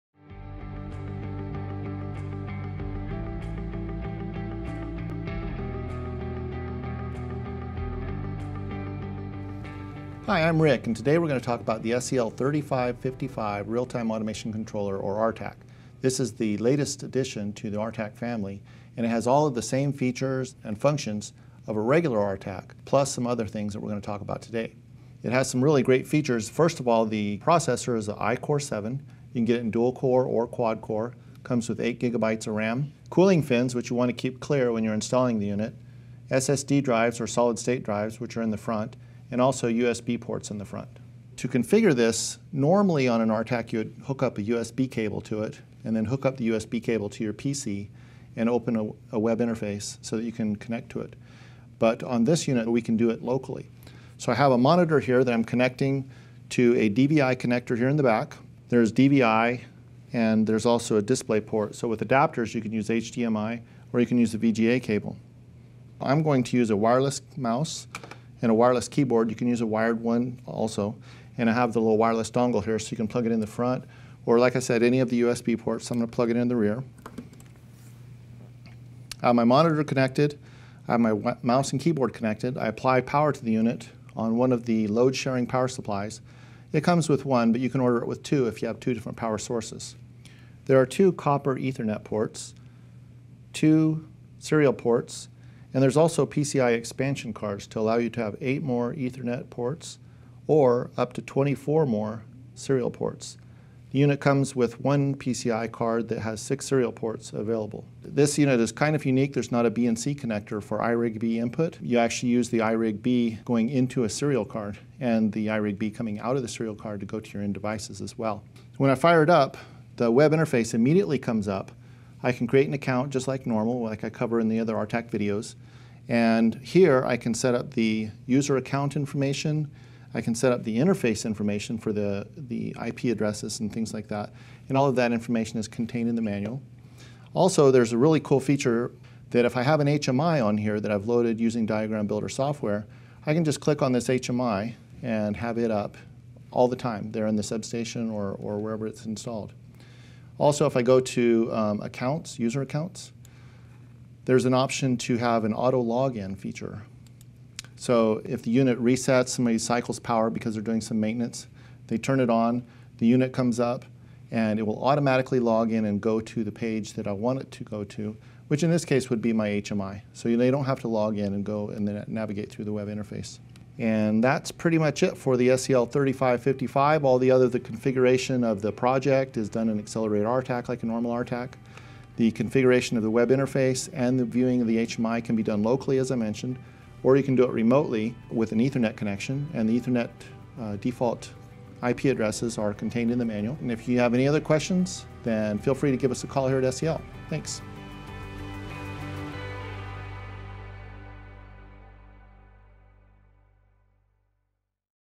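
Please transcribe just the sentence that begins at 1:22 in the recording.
I apply power to the unit on one of the load sharing power supplies.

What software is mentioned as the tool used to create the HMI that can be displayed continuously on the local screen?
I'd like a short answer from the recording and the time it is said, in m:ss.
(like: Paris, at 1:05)
Diagram Builder, at 2:21.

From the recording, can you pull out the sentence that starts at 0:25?
It has some really great features.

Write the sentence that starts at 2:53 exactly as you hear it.
And that's pretty much it for the SEL 3555.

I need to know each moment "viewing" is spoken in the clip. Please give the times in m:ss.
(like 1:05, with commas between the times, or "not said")
3:04.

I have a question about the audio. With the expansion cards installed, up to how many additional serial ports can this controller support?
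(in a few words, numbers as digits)
24.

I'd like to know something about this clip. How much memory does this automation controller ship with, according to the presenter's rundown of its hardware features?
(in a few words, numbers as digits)
8 GB.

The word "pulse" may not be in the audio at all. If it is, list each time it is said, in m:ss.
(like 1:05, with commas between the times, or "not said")
not said.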